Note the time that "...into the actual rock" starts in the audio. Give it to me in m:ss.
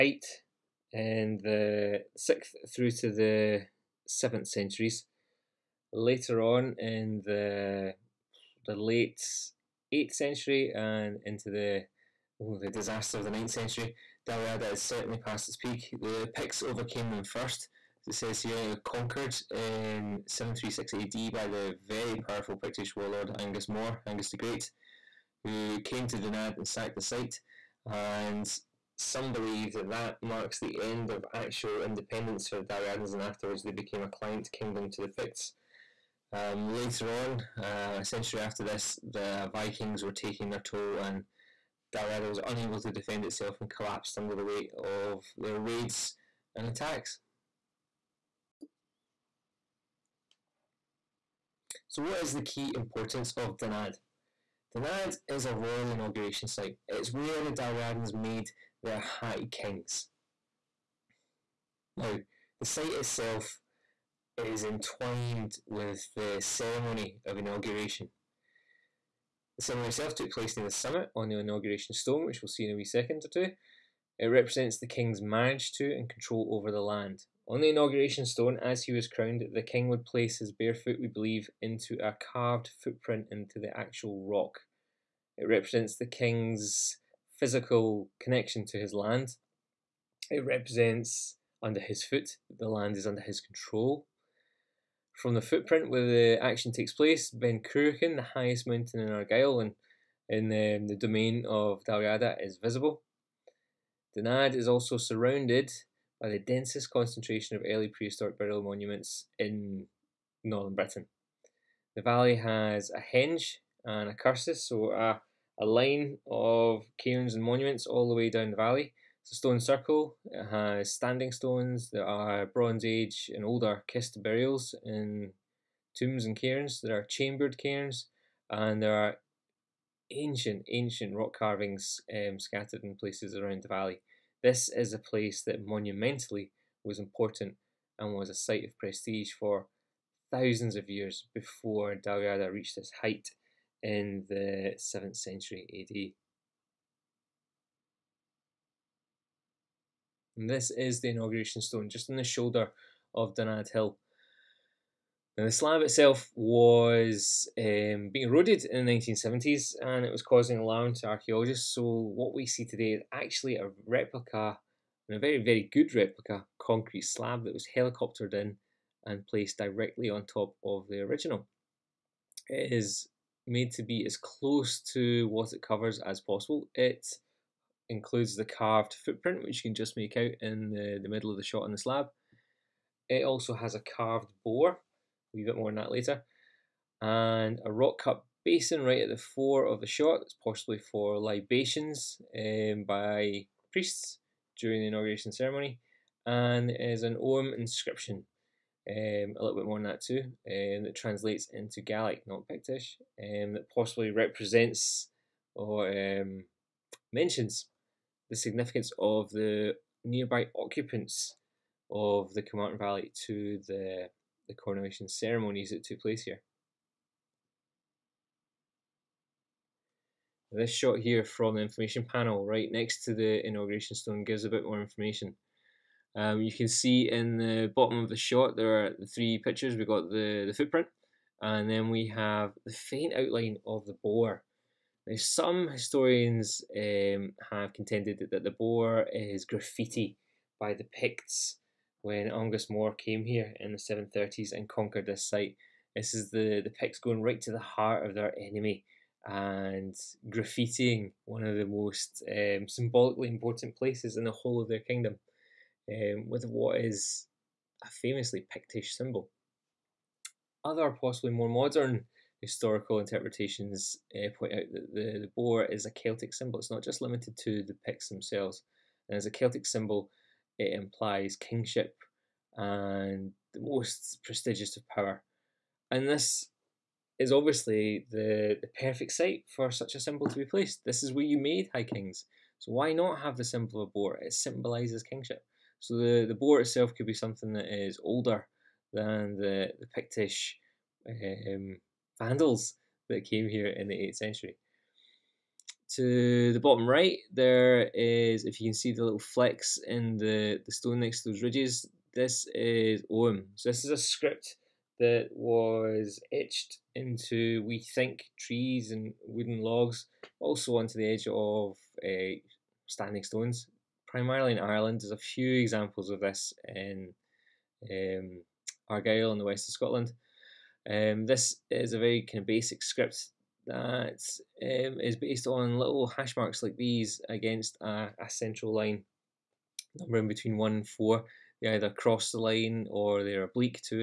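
1:23.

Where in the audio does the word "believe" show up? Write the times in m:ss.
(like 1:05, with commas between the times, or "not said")
0:29, 1:21.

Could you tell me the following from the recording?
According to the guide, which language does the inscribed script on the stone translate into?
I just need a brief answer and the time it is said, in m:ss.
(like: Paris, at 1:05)
Gaelic, at 3:21.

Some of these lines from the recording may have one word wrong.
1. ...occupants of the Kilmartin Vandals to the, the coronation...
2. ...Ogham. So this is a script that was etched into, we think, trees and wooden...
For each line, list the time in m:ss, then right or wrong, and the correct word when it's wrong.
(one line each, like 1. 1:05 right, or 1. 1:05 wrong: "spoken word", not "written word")
1. 3:30 wrong: "Valley", not "Vandals"
2. 5:03 right.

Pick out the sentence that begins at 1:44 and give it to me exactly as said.
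Dunadd is also surrounded by the densest concentration of early prehistoric burial monuments in northern Britain.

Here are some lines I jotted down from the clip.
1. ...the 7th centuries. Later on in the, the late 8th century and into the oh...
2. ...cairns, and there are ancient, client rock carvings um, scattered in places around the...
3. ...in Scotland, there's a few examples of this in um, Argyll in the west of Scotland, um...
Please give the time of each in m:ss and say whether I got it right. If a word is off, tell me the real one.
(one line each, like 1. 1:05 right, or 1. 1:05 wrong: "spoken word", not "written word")
1. 0:03 right
2. 2:07 wrong: "ancient", not "client"
3. 5:14 wrong: "Ireland", not "Scotland".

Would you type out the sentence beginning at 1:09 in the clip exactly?
The ceremony itself took place near the summit on the inauguration stone, which we'll see in a wee second or two.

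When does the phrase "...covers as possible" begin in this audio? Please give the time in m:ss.
2:55.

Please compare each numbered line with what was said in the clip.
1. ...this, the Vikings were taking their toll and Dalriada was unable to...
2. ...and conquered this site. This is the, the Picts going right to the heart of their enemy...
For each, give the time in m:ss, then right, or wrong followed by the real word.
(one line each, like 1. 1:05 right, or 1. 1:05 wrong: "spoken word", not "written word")
1. 0:38 right
2. 4:04 right.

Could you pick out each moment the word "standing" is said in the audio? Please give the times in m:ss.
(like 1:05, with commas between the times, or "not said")
2:00, 5:12.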